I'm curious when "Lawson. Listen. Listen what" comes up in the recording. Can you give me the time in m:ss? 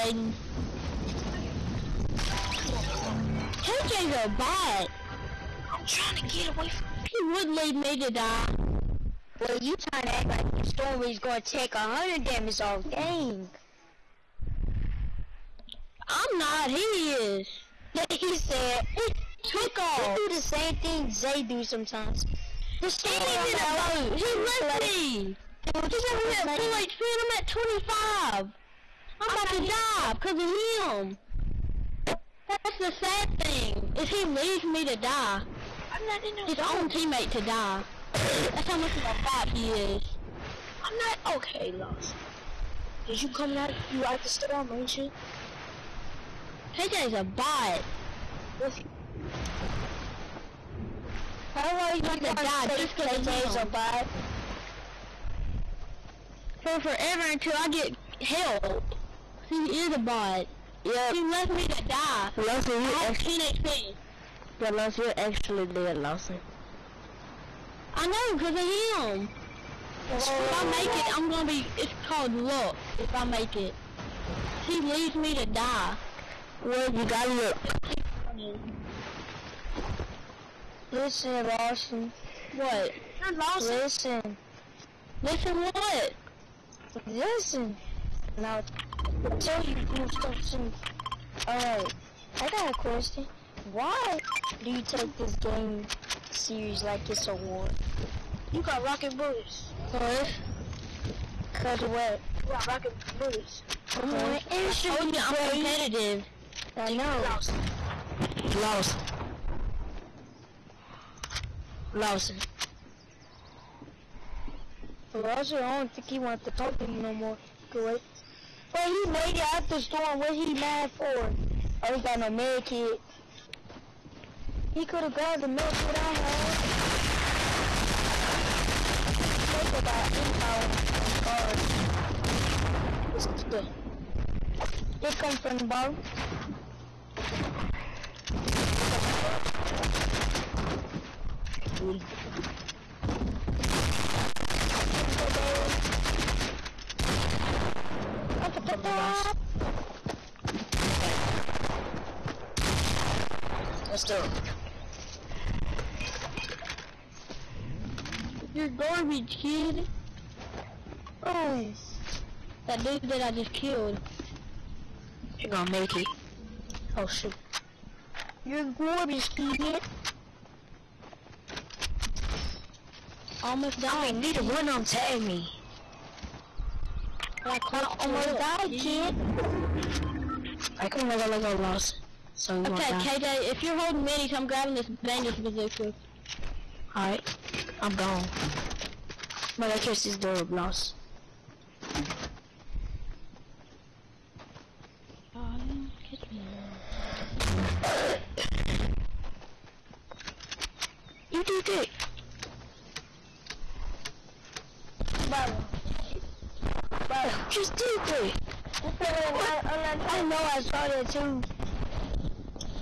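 1:23.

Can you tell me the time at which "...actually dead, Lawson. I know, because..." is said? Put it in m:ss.
1:05.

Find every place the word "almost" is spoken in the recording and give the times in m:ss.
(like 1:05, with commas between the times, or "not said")
2:53, 2:58.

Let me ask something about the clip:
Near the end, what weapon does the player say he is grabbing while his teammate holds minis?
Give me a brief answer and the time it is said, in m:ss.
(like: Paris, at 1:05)
bandage bazooka, at 3:05.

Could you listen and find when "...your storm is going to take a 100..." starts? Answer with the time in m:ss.
0:10.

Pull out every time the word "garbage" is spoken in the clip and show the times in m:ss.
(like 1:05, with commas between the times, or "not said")
2:38, 2:48.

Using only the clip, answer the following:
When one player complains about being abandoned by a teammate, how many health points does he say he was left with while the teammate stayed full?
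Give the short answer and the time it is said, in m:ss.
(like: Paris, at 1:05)
25, at 0:27.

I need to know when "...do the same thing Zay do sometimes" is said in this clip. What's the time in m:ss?
0:20.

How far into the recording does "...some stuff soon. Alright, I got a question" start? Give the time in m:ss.
1:29.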